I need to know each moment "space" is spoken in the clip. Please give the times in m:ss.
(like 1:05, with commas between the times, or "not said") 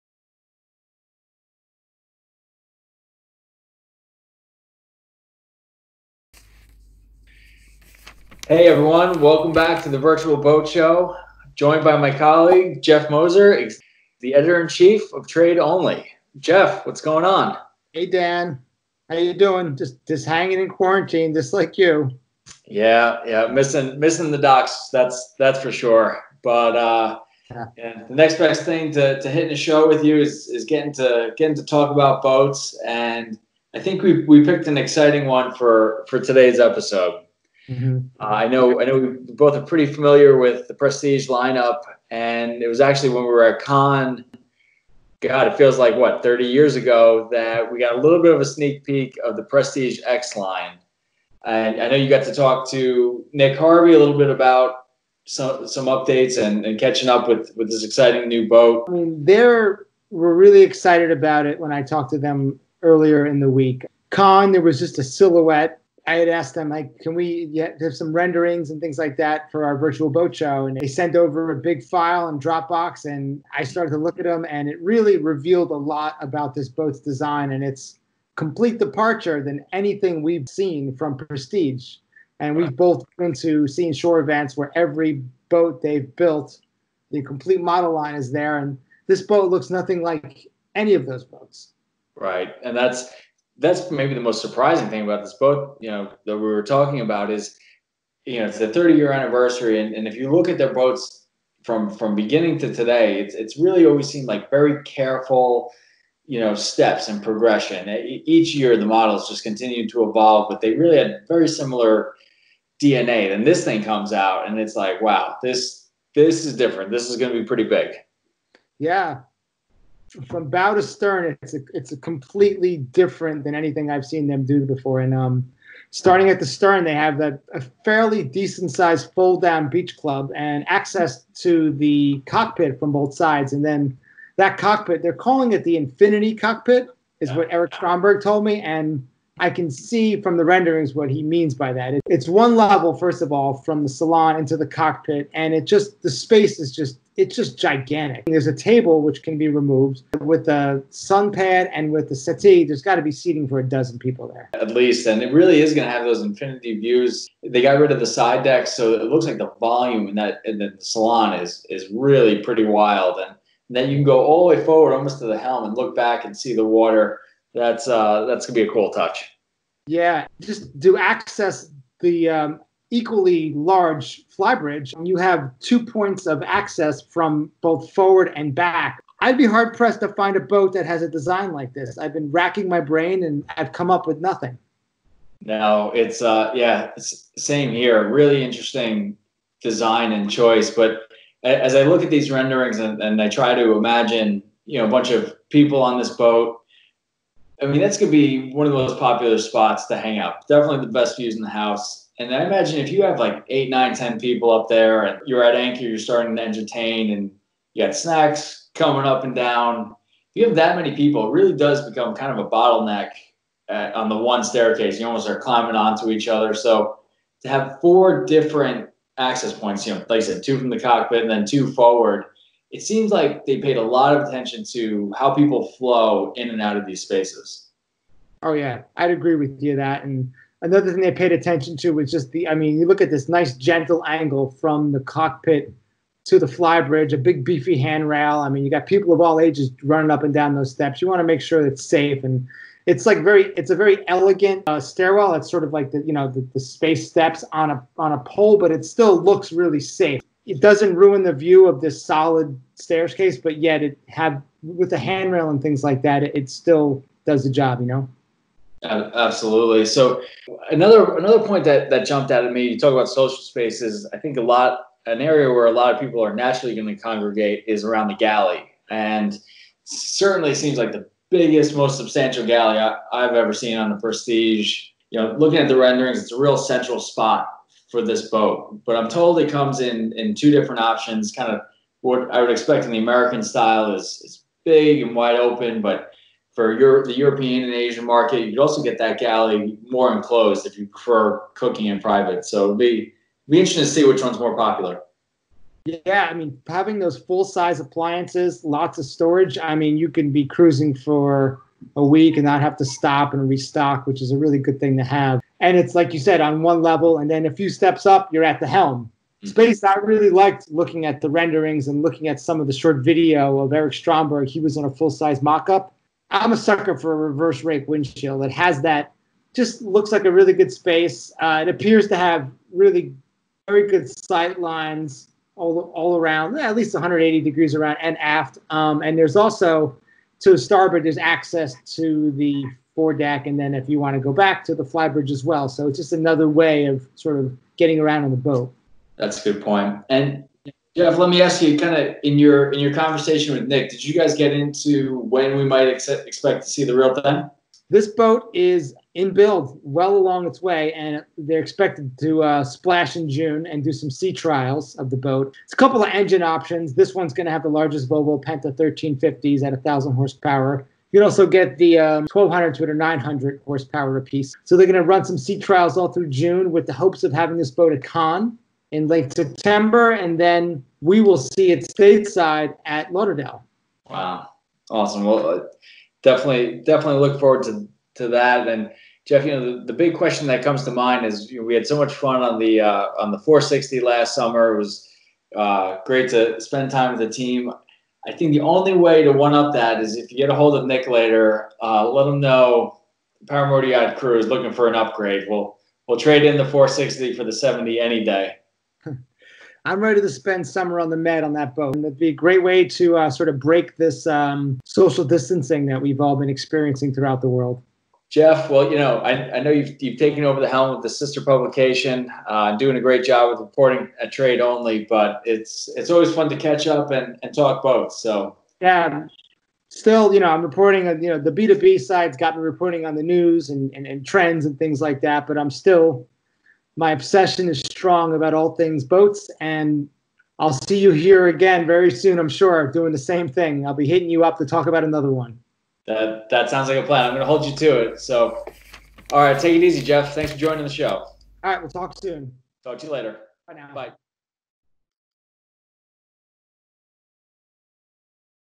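2:26, 3:47, 4:06, 4:23, 5:09, 5:20.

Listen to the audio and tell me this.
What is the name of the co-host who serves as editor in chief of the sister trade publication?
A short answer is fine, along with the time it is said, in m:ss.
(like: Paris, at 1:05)
Jeff Moser, at 0:12.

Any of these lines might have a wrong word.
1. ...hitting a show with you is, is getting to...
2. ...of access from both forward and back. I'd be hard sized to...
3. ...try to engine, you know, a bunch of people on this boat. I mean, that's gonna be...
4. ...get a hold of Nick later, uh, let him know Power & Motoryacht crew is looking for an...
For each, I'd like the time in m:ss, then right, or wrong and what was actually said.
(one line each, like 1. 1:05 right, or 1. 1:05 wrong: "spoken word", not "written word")
1. 0:29 right
2. 2:56 wrong: "pressed", not "sized"
3. 3:13 wrong: "imagine", not "engine"
4. 6:30 right.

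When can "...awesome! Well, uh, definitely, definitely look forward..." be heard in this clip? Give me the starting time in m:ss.
6:14.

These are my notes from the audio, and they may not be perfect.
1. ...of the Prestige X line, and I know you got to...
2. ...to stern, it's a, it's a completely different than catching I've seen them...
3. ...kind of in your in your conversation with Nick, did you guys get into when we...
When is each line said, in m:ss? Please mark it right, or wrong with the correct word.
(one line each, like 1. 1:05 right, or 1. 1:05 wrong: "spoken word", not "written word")
1. 0:49 right
2. 2:00 wrong: "anything", not "catching"
3. 5:41 right.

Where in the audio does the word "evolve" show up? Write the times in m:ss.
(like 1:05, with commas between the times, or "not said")
1:50.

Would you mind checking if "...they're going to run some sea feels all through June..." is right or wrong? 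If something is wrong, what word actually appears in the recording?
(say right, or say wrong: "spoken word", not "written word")
wrong: "trials", not "feels".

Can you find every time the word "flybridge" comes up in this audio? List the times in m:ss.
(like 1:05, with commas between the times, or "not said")
2:54, 3:56, 5:34.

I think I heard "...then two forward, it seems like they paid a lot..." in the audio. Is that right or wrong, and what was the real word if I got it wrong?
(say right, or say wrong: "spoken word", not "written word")
right.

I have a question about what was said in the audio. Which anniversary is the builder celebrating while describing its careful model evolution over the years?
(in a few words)
30 year.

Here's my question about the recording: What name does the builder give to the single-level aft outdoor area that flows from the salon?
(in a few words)
infinity cockpit.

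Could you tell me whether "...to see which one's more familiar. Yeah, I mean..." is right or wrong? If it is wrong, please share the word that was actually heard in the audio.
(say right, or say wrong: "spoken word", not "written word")
wrong: "popular", not "familiar".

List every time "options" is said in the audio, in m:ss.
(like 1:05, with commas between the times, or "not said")
4:40, 5:56.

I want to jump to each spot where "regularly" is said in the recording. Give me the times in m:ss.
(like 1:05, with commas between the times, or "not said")
not said.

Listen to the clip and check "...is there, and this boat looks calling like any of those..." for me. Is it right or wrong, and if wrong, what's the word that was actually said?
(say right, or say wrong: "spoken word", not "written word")
wrong: "nothing", not "calling".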